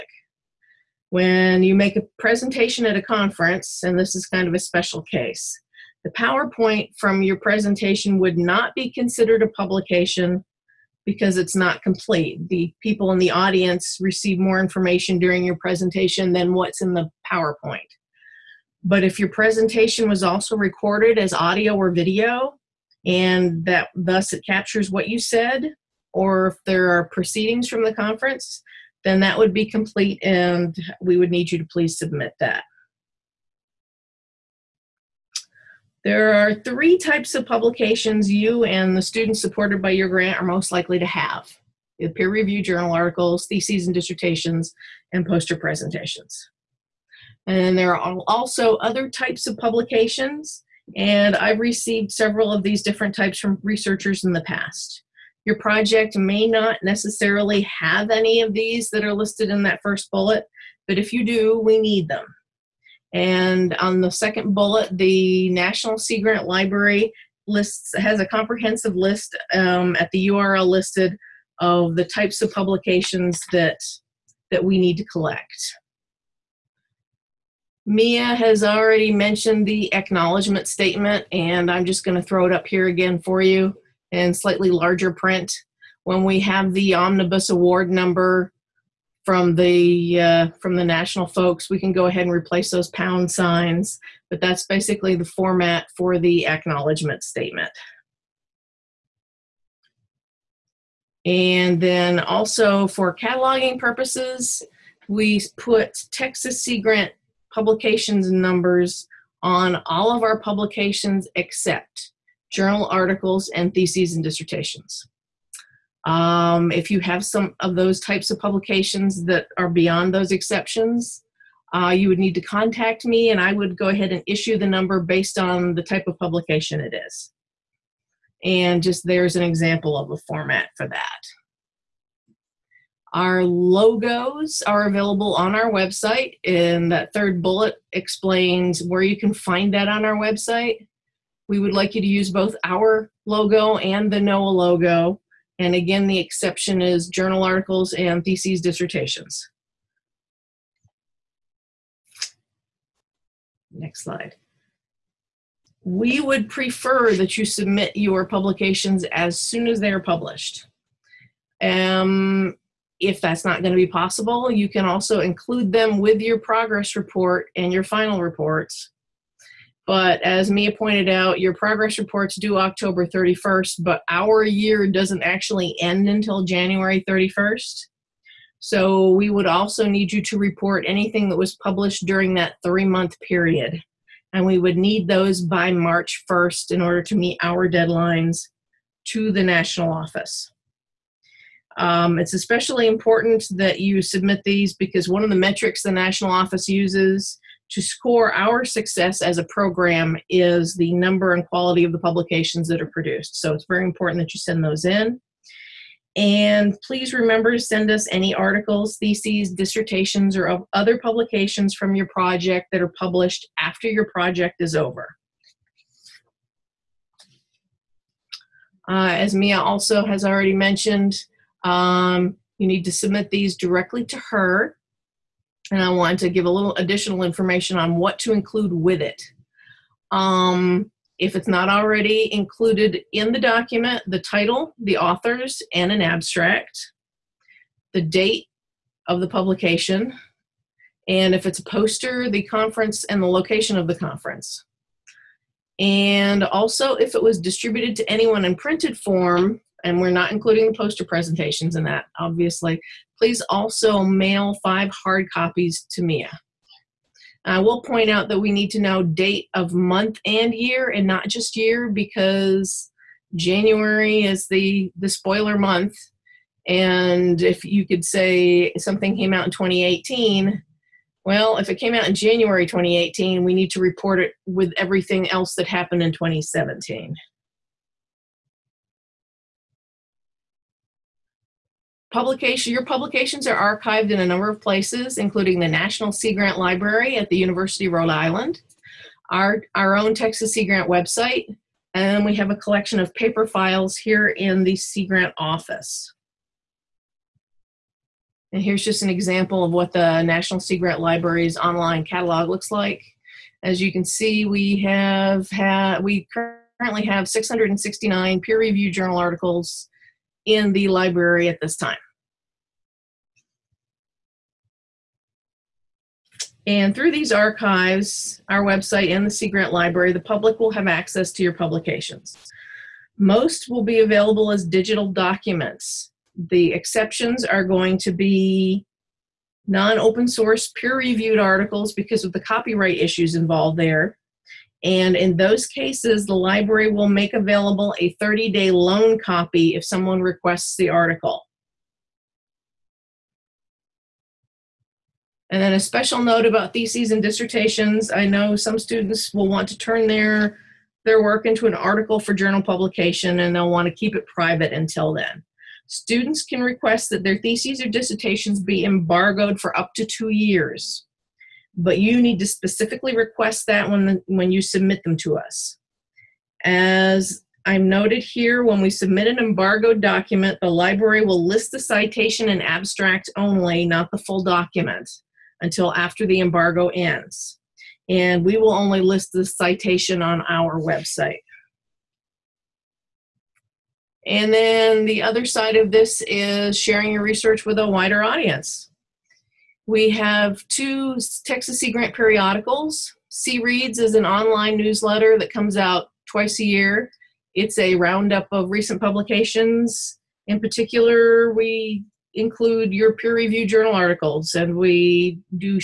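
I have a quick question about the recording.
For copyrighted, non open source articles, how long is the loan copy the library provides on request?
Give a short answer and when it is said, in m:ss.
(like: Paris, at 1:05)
30 days, at 5:38.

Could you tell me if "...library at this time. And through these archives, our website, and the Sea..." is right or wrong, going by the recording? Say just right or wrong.
right.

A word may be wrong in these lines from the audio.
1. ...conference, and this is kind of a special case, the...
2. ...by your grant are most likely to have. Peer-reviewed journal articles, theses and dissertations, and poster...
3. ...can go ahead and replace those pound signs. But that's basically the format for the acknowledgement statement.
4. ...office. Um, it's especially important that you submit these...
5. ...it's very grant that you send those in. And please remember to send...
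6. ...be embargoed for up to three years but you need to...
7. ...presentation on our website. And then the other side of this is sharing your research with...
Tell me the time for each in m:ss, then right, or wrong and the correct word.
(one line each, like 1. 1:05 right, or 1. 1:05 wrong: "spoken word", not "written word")
1. 0:03 right
2. 0:39 right
3. 1:31 right
4. 3:09 right
5. 3:23 wrong: "important", not "grant"
6. 5:58 wrong: "two", not "three"
7. 6:19 wrong: "citation", not "presentation".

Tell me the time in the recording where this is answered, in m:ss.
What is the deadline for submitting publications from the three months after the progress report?
3:05.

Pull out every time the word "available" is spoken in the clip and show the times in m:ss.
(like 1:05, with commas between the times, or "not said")
2:14, 5:24, 5:37.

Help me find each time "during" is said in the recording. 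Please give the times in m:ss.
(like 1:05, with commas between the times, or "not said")
0:15, 3:02.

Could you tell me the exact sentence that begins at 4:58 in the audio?
And here's just an example of what the National Sea Grant Library's online catalog looks like.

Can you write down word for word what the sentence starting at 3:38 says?
Uh, as Mia also has already mentioned, um, you need to submit these directly to her.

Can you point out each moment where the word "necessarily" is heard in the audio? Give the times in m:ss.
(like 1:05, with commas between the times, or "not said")
0:56.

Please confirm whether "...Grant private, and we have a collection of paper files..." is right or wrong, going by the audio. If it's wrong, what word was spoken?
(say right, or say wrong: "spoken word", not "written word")
wrong: "website", not "private".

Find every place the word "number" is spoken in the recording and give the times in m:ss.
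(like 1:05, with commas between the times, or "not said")
1:27, 1:48, 2:04, 3:20, 4:44.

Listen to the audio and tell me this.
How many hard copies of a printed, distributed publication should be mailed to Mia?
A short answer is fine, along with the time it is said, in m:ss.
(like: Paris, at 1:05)
5, at 4:14.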